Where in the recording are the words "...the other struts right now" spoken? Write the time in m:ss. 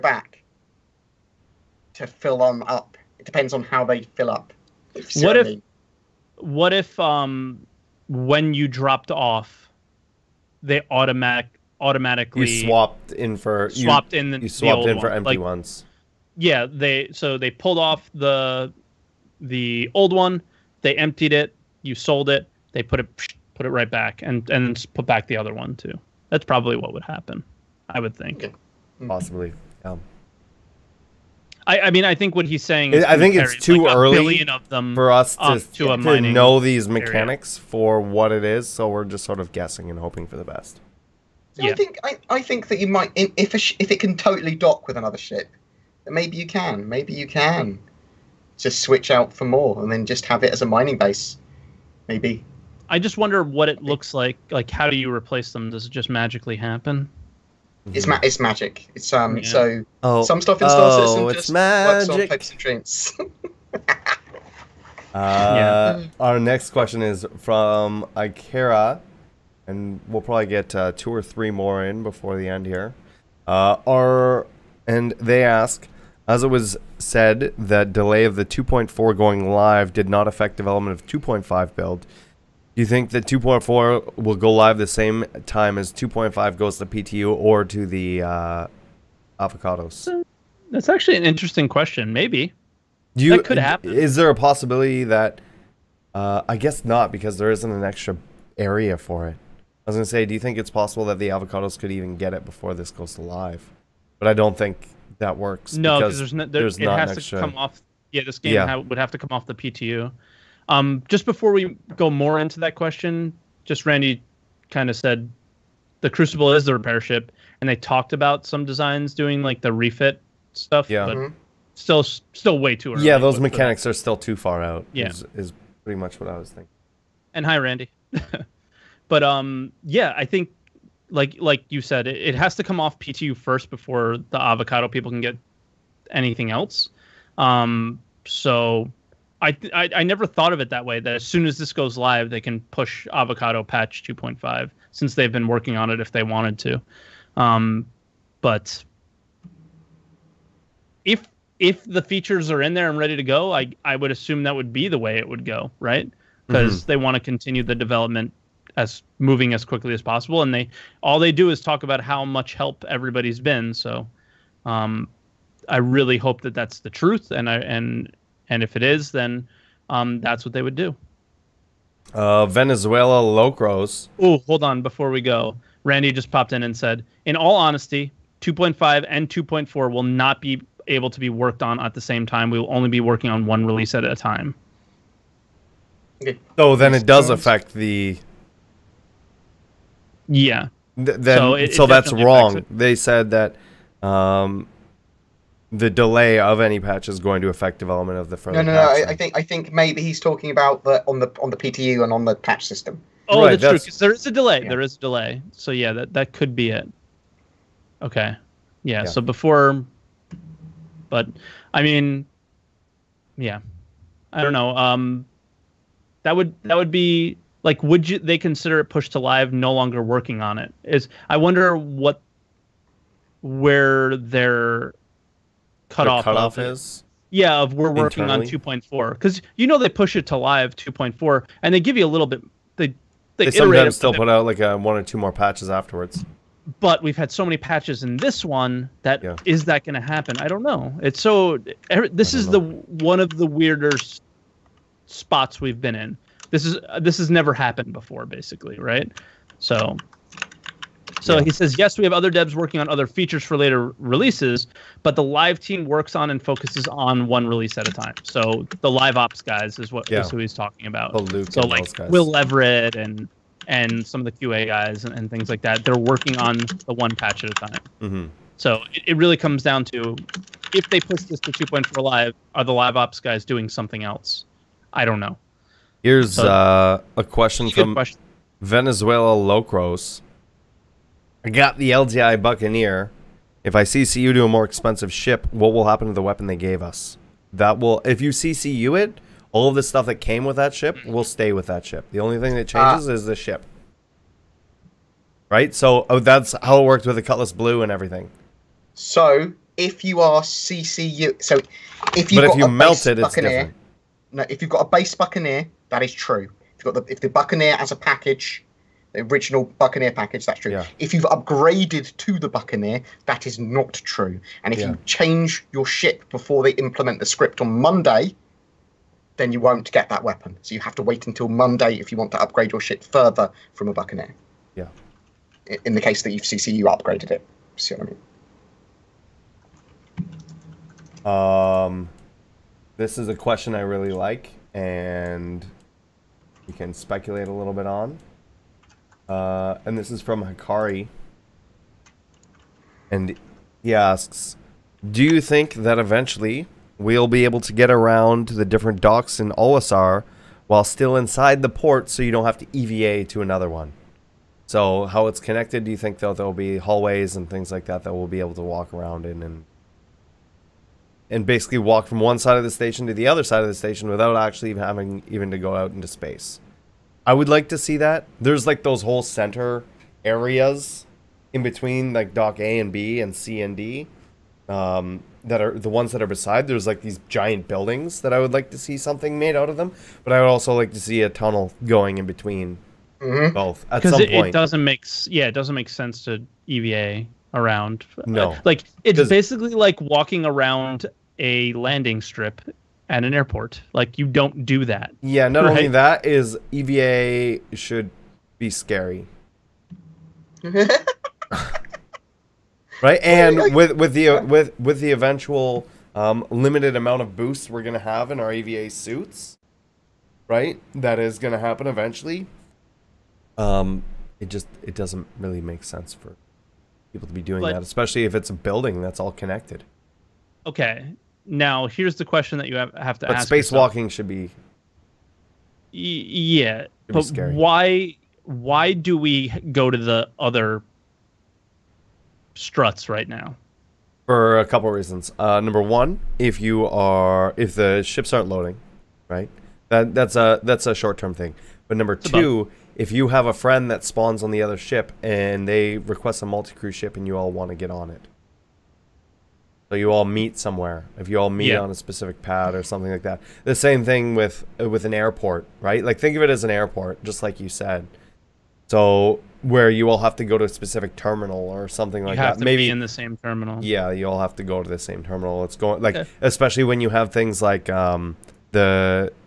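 7:09.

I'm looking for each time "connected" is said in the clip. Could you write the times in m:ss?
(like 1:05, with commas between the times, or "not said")
5:55, 6:59.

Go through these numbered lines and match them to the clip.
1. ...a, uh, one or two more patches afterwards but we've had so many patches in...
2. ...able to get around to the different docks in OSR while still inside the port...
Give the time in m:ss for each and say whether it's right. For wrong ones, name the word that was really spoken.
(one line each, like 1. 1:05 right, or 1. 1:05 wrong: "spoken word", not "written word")
1. 3:54 right
2. 5:47 right.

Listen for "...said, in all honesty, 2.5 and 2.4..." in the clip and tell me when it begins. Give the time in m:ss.
2:56.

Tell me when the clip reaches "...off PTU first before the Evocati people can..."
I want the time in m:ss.
2:12.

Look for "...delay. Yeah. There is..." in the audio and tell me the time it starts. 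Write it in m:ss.
3:24.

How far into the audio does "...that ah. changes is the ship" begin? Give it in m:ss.
4:52.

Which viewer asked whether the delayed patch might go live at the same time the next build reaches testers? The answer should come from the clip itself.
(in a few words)
Ikera.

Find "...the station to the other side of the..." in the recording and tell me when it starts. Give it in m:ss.
6:02.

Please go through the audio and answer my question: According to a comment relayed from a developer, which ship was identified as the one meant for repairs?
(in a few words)
Crucible.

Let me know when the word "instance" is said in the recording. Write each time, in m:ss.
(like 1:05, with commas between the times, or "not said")
not said.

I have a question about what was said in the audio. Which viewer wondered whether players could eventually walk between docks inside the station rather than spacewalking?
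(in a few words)
Hikari.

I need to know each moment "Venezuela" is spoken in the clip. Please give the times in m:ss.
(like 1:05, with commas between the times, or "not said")
2:52, 4:38.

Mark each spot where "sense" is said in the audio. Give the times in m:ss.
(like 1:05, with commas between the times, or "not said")
6:25, 6:55.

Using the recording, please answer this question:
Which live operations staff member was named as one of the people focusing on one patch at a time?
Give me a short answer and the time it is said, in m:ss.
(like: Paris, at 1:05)
Will Leverett, at 4:22.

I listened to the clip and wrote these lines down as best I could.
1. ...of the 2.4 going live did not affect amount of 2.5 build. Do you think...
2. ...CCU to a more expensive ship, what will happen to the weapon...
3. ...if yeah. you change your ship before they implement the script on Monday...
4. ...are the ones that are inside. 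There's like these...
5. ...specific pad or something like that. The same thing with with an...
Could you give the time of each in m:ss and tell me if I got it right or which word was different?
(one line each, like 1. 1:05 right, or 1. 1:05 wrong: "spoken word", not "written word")
1. 1:18 wrong: "development", not "amount"
2. 4:43 right
3. 5:14 right
4. 6:15 wrong: "beside", not "inside"
5. 7:31 right.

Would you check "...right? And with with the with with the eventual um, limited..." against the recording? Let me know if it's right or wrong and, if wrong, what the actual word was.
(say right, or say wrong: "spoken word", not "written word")
right.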